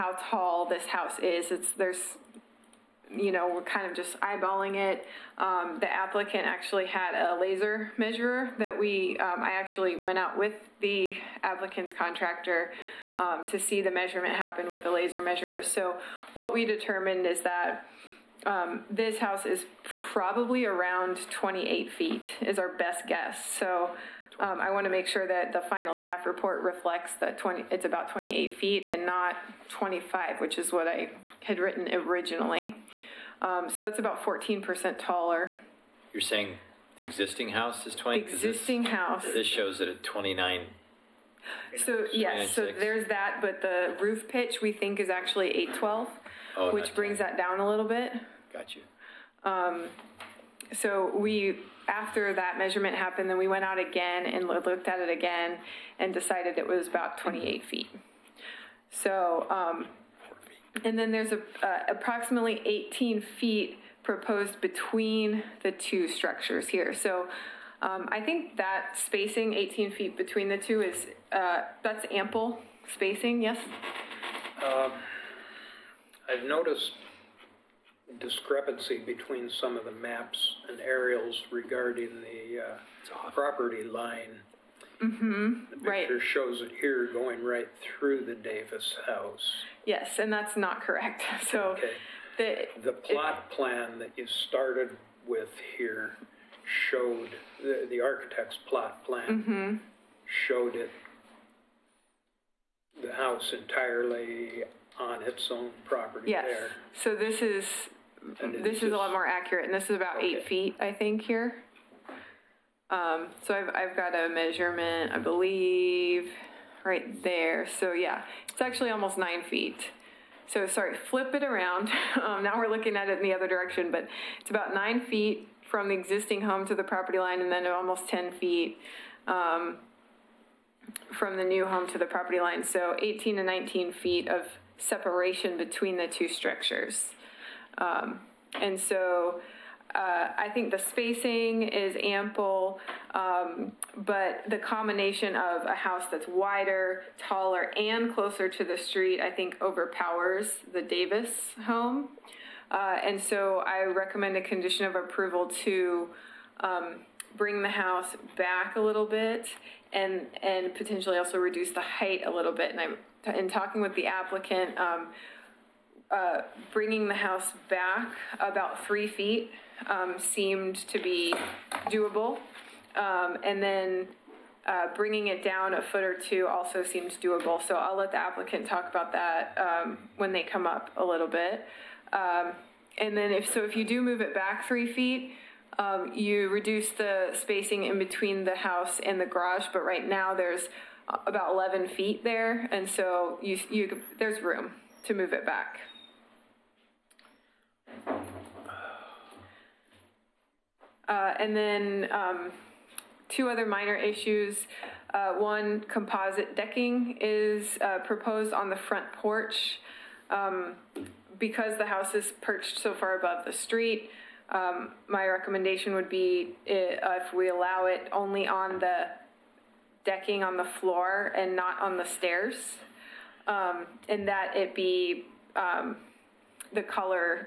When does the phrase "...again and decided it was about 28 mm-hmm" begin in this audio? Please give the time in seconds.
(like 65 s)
55 s.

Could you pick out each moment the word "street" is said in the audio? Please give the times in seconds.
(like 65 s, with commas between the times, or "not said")
148 s, 213 s.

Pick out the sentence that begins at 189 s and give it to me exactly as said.
But right now there's about 11 feet there, and so you you there's room to move it back.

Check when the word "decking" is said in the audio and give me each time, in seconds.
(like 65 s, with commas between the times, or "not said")
206 s, 220 s.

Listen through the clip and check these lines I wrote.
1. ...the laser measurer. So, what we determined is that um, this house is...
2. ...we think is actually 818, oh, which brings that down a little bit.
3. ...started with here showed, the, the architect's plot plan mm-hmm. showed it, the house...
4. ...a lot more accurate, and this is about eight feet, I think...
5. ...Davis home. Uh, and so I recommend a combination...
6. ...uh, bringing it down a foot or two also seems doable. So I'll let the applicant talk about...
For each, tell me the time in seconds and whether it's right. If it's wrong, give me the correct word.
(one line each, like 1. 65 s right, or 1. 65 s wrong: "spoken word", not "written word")
1. 14 s right
2. 44 s wrong: "812", not "818"
3. 94 s right
4. 108 s right
5. 150 s wrong: "condition", not "combination"
6. 174 s right.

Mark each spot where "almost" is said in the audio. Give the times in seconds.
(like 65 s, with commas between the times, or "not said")
118 s, 127 s.